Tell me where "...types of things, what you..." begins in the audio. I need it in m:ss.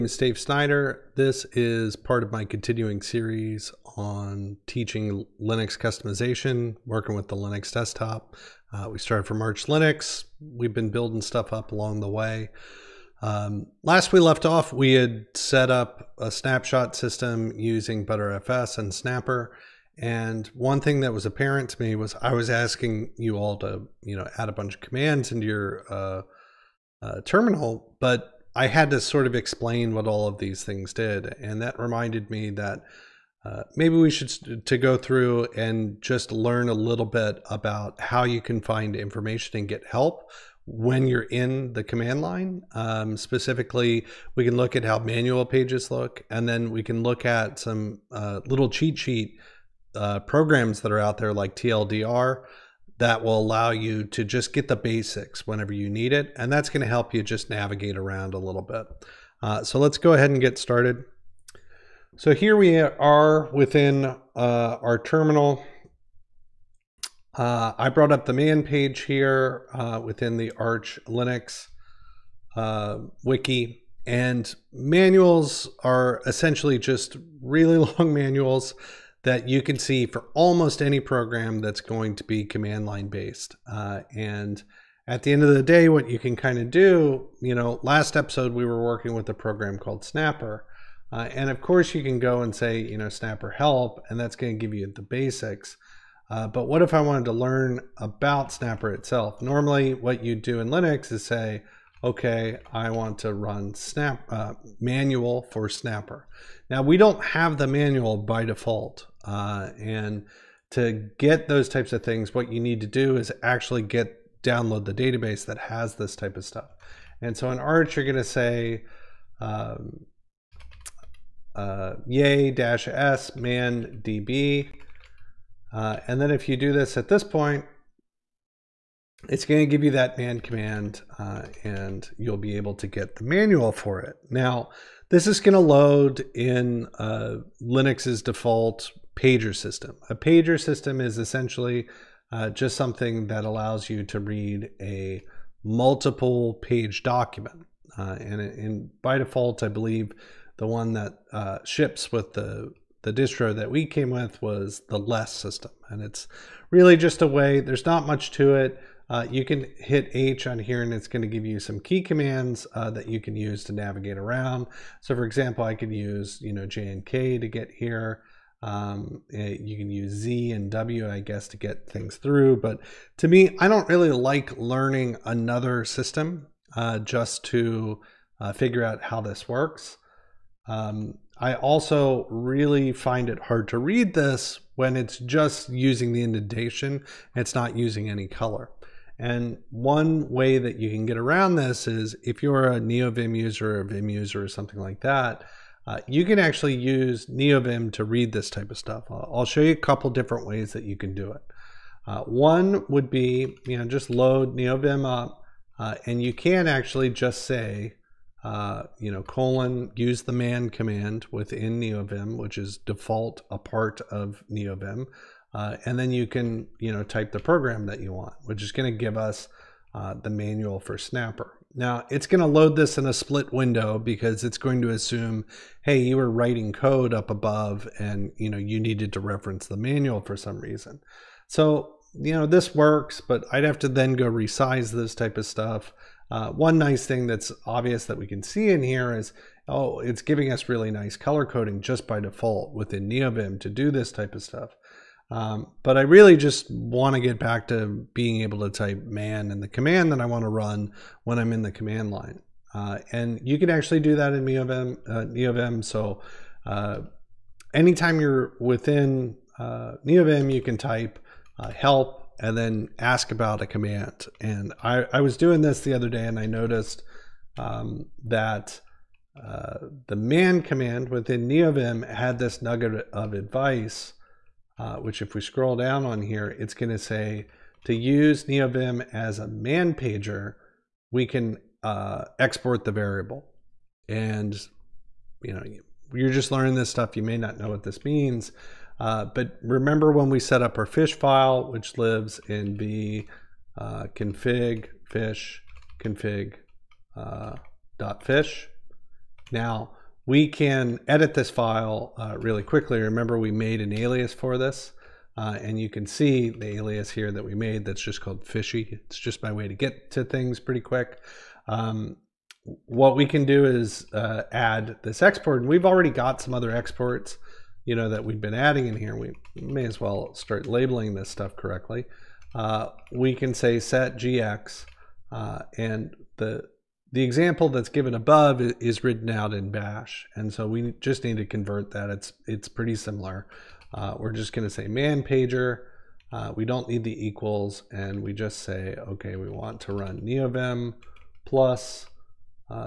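1:51.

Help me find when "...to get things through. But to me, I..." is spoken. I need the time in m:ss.
2:51.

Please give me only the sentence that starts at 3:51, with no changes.
So you know this works, but I'd have to then go resize this type of stuff.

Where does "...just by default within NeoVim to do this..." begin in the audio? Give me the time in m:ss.
4:01.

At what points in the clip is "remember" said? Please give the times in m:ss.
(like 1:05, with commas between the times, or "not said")
4:49, 5:03.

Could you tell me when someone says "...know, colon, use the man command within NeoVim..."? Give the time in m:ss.
3:29.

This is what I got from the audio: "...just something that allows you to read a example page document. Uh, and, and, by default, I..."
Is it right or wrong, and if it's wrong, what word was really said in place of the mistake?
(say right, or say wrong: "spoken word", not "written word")
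wrong: "multiple", not "example".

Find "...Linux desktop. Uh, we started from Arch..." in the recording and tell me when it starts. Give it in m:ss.
0:07.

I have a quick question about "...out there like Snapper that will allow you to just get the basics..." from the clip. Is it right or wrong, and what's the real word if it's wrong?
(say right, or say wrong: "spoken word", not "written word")
wrong: "TLDR", not "Snapper".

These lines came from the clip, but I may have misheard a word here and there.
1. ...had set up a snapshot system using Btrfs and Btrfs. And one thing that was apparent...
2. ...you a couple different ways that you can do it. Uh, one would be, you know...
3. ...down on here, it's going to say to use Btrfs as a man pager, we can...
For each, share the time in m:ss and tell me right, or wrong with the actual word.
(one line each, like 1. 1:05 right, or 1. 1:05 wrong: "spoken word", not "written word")
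1. 0:14 wrong: "Snapper", not "Btrfs"
2. 3:19 right
3. 4:35 wrong: "NeoVim", not "Btrfs".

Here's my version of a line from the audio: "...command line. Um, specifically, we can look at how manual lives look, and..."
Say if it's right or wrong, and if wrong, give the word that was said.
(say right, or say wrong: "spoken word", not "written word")
wrong: "pages", not "lives".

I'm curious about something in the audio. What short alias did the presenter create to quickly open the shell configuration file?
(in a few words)
fishy.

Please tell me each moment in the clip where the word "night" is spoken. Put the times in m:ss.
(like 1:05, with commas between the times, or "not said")
not said.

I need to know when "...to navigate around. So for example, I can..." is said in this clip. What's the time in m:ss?
2:43.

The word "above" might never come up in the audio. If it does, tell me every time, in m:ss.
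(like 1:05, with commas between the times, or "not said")
3:47, 5:28.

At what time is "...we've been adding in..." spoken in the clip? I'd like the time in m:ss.
5:18.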